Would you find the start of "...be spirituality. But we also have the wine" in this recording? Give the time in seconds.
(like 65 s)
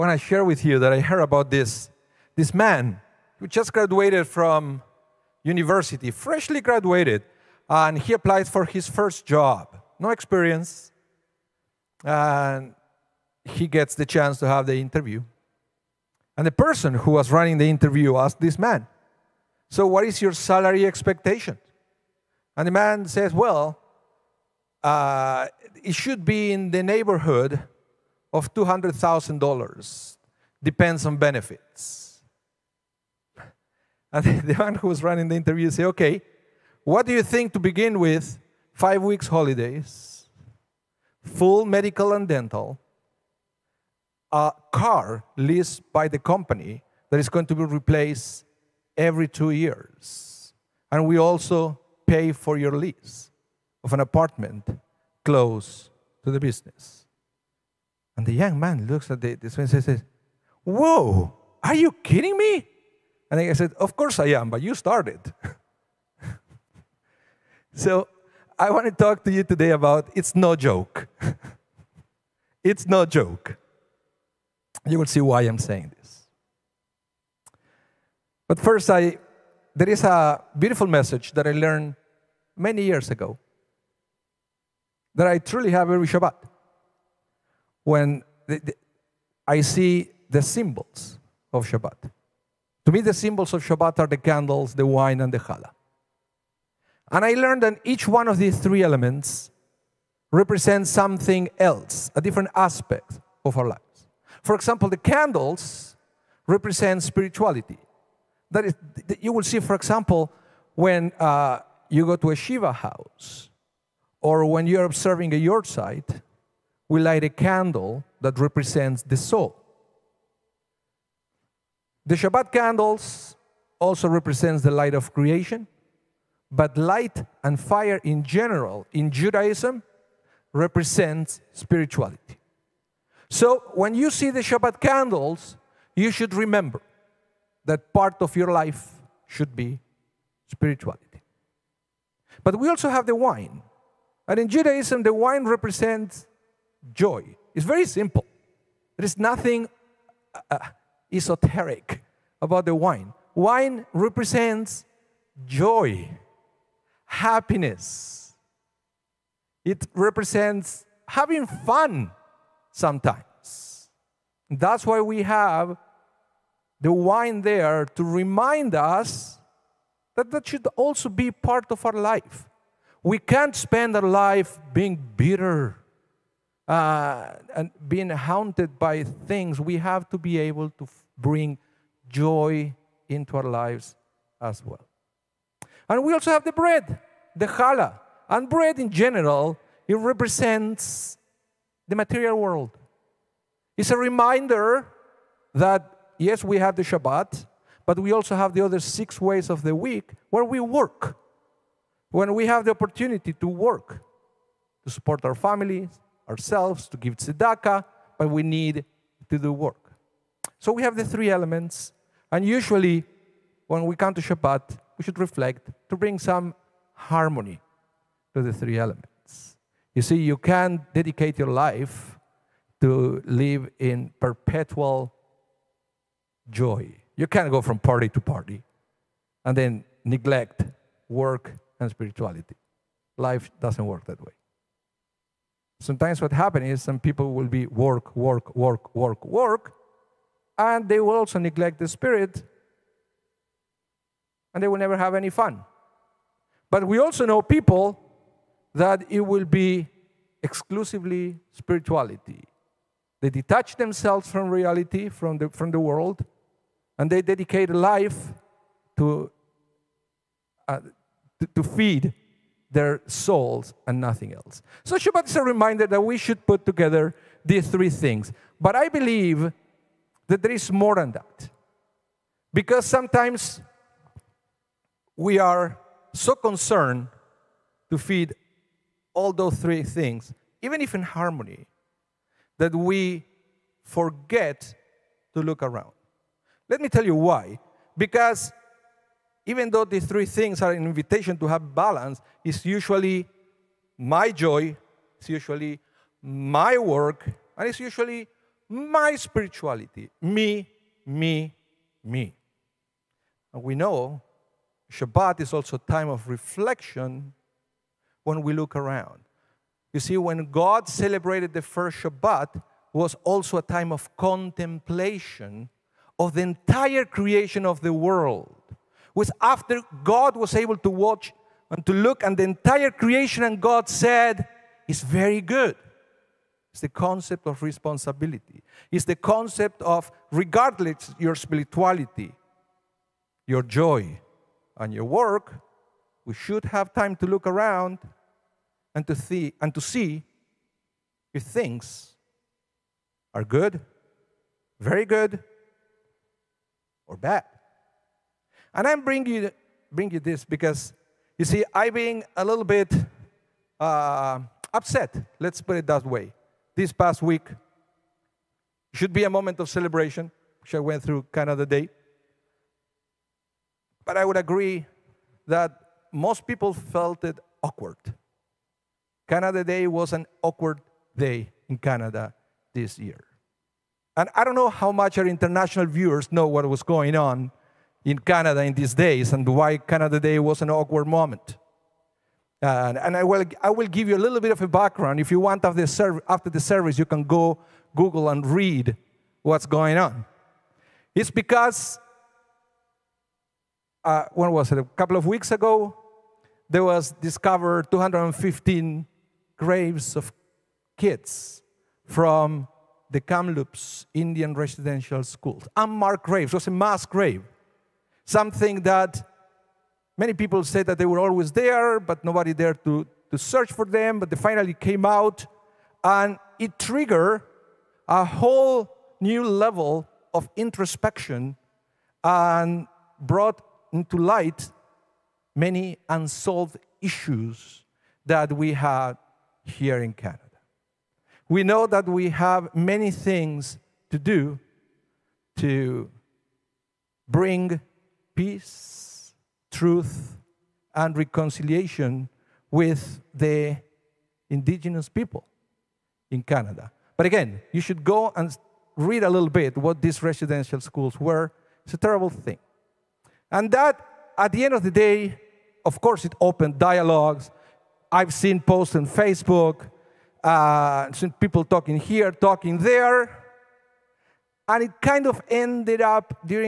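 139 s.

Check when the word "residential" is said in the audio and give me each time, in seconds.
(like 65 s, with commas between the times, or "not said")
404 s, 450 s.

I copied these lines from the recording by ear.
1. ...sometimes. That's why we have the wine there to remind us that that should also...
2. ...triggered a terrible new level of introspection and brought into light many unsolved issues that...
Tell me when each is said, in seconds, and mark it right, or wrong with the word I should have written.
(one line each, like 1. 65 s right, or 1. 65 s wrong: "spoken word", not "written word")
1. 162 s right
2. 416 s wrong: "whole", not "terrible".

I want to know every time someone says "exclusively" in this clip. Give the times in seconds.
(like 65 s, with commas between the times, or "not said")
250 s.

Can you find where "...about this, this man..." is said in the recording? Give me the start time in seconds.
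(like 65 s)
1 s.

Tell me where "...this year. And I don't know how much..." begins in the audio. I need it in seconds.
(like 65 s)
372 s.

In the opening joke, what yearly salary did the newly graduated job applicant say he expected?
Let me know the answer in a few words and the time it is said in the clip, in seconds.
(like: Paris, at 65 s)
$200,000, at 28 s.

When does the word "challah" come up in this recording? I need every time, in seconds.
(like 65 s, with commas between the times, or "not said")
95 s, 187 s.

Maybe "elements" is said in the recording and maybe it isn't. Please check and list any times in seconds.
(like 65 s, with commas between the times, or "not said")
98 s, 211 s, 218 s.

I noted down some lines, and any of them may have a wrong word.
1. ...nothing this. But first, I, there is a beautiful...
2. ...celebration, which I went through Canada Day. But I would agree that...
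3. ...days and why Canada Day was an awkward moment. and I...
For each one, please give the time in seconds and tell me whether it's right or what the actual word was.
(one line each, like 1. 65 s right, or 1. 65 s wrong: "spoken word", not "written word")
1. 75 s wrong: "saying", not "nothing"
2. 359 s right
3. 378 s right.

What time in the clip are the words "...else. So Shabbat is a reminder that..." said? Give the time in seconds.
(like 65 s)
264 s.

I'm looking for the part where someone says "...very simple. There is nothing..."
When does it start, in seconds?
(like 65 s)
147 s.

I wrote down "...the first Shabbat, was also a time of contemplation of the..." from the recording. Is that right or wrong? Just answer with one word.
right.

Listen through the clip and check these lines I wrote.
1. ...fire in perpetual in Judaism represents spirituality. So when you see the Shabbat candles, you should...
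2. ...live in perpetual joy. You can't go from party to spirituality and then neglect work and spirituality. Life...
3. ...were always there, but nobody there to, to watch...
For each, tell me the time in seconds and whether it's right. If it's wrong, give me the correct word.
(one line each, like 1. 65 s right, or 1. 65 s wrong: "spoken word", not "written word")
1. 127 s wrong: "general", not "perpetual"
2. 223 s wrong: "party", not "spirituality"
3. 411 s wrong: "search", not "watch".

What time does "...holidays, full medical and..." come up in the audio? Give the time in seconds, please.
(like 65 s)
39 s.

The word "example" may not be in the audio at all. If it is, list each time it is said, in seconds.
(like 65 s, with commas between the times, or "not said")
104 s, 109 s.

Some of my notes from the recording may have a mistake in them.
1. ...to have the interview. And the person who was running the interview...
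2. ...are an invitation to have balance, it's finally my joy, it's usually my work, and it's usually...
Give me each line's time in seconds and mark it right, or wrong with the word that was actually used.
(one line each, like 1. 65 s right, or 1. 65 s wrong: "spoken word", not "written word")
1. 14 s right
2. 290 s wrong: "usually", not "finally".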